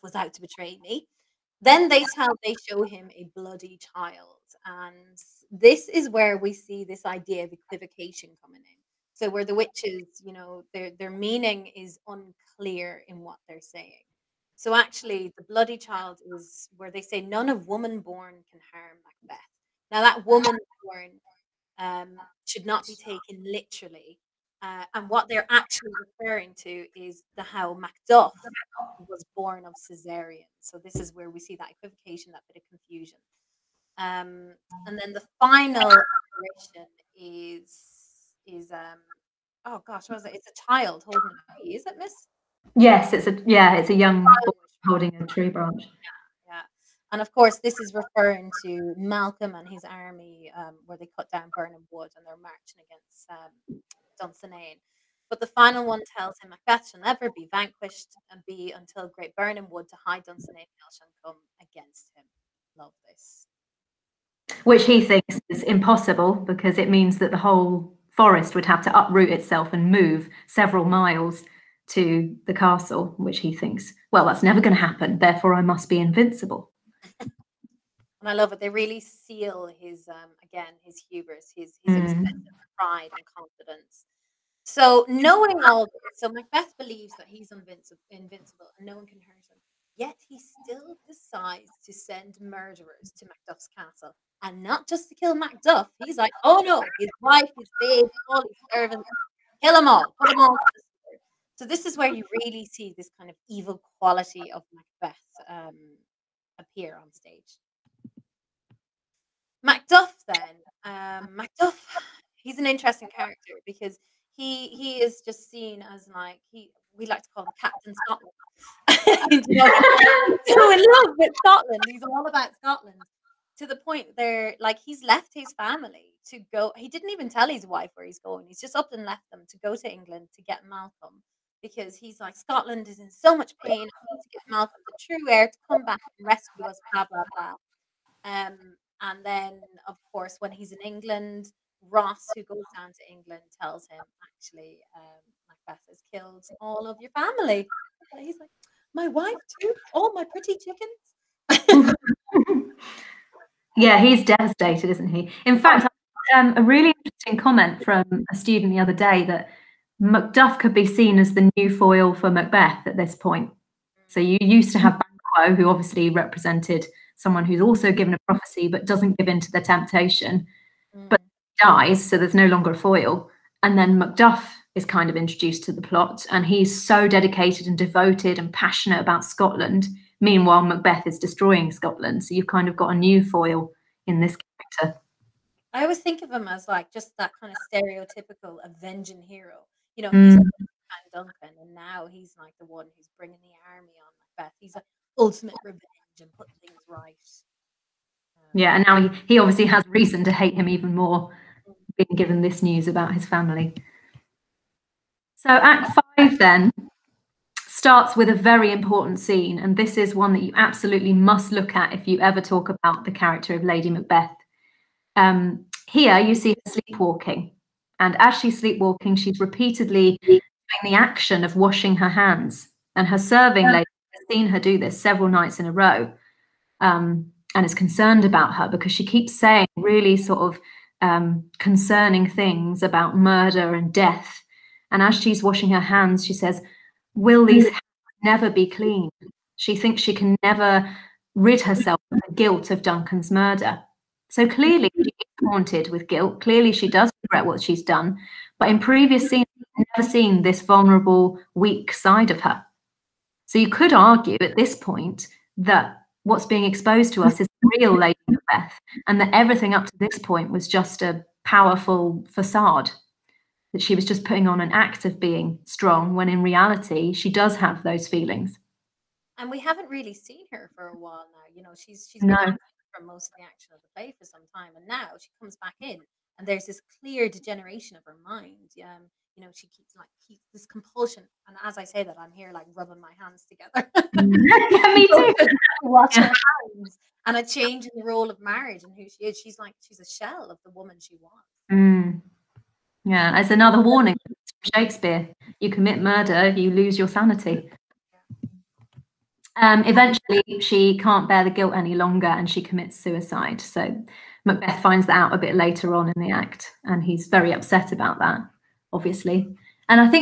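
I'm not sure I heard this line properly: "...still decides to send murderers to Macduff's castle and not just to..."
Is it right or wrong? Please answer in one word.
right.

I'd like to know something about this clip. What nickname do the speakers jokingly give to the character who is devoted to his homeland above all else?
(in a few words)
Captain Scotland.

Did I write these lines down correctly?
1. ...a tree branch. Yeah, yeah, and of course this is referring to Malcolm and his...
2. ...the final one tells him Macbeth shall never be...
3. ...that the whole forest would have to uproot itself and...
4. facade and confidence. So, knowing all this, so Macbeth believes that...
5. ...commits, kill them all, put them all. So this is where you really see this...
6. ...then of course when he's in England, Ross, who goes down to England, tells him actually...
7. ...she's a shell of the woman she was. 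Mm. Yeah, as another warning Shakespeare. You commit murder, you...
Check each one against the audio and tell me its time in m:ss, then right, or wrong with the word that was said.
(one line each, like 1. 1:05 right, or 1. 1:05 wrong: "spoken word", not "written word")
1. 0:45 right
2. 0:55 right
3. 1:07 right
4. 1:22 wrong: "pride", not "facade"
5. 1:38 wrong: "servants", not "commits"
6. 2:19 right
7. 4:49 right.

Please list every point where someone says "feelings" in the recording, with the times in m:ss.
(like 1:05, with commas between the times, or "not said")
4:28.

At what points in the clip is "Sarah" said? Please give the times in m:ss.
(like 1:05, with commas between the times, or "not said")
not said.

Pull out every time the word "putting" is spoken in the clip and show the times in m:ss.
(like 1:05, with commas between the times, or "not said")
3:16, 4:24.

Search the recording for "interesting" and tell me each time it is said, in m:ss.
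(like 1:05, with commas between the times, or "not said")
1:52, 2:37.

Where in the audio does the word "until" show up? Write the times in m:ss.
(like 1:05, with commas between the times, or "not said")
0:58.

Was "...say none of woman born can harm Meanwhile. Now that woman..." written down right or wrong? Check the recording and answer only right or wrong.
wrong.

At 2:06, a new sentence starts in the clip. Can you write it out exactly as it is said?
He didn't even tell his wife where he's going.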